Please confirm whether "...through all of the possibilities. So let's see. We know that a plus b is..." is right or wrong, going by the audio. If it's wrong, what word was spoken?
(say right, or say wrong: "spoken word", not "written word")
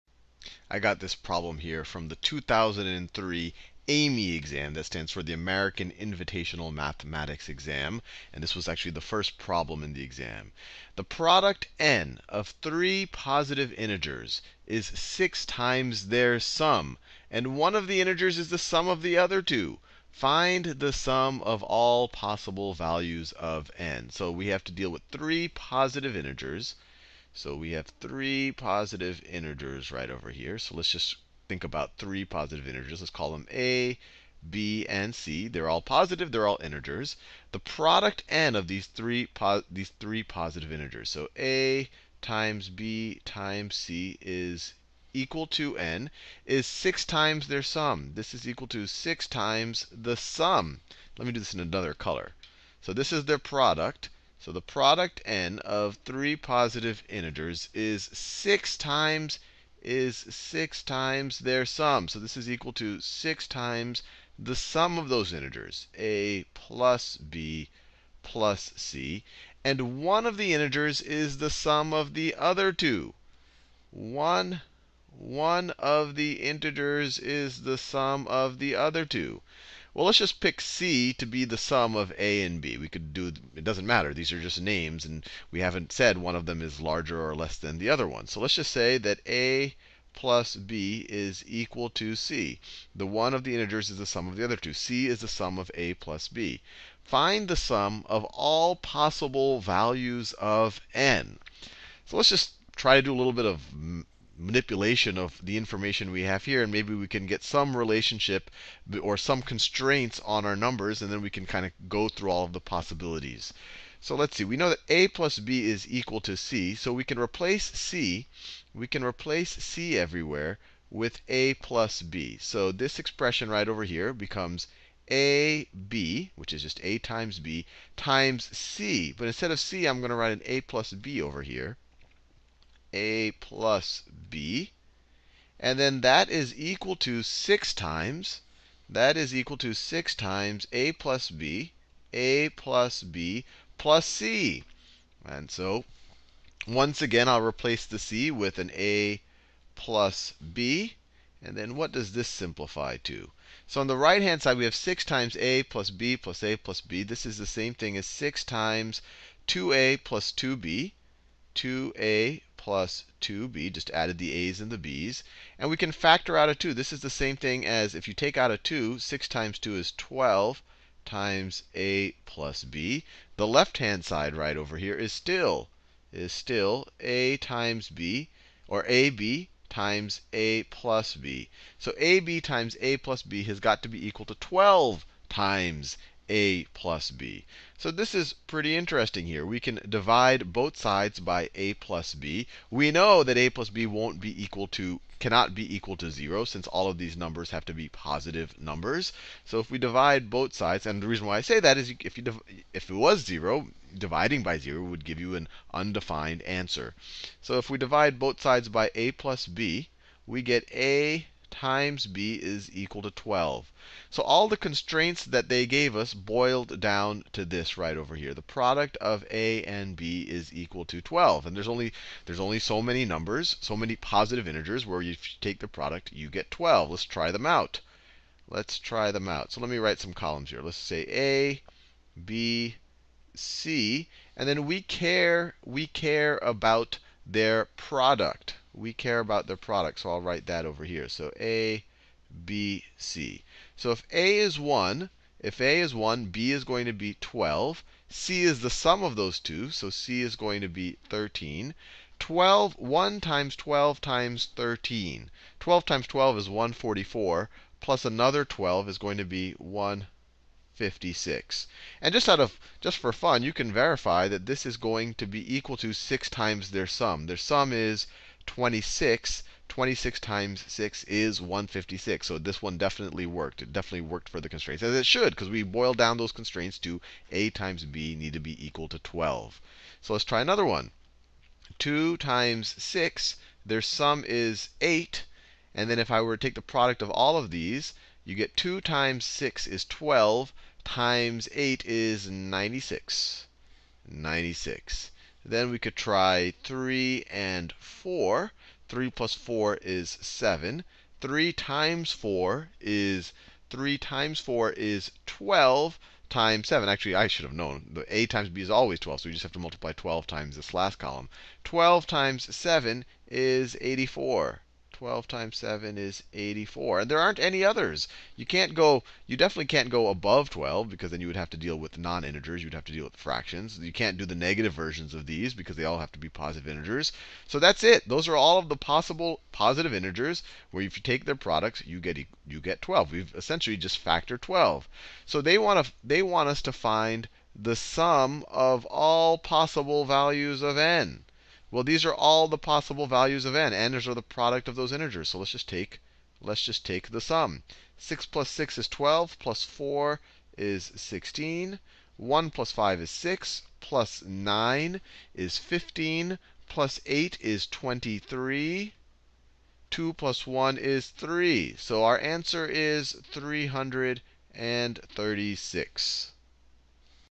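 right.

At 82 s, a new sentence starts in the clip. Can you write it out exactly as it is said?
We could do, it doesn't matter.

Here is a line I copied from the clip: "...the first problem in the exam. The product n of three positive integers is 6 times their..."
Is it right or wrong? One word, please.
right.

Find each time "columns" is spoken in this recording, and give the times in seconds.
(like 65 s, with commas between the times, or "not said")
230 s, 310 s.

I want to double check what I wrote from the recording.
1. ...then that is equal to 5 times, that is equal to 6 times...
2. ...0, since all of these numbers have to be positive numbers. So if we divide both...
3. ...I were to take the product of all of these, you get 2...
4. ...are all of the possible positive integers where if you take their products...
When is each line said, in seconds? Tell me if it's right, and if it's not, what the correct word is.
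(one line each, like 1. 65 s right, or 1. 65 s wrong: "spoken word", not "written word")
1. 135 s wrong: "6", not "5"
2. 196 s right
3. 286 s right
4. 328 s right.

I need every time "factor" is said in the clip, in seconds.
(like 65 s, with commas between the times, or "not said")
165 s, 333 s.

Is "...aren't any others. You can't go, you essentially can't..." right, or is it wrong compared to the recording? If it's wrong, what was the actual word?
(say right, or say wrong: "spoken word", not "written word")
wrong: "definitely", not "essentially".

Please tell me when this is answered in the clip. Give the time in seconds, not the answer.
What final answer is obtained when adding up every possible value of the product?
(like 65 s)
363 s.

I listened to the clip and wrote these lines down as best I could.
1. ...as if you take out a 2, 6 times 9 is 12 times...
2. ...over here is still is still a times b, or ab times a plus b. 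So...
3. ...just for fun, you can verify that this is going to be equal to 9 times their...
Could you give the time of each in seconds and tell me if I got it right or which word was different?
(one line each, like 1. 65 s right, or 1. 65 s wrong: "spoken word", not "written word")
1. 167 s wrong: "2", not "9"
2. 174 s right
3. 262 s wrong: "6", not "9".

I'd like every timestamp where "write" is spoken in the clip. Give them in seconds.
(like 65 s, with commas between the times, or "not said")
130 s, 229 s, 240 s.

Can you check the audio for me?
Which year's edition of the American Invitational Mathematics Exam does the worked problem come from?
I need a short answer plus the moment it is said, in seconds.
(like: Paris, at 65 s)
2003, at 2 s.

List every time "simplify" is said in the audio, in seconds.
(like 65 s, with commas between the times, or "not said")
152 s.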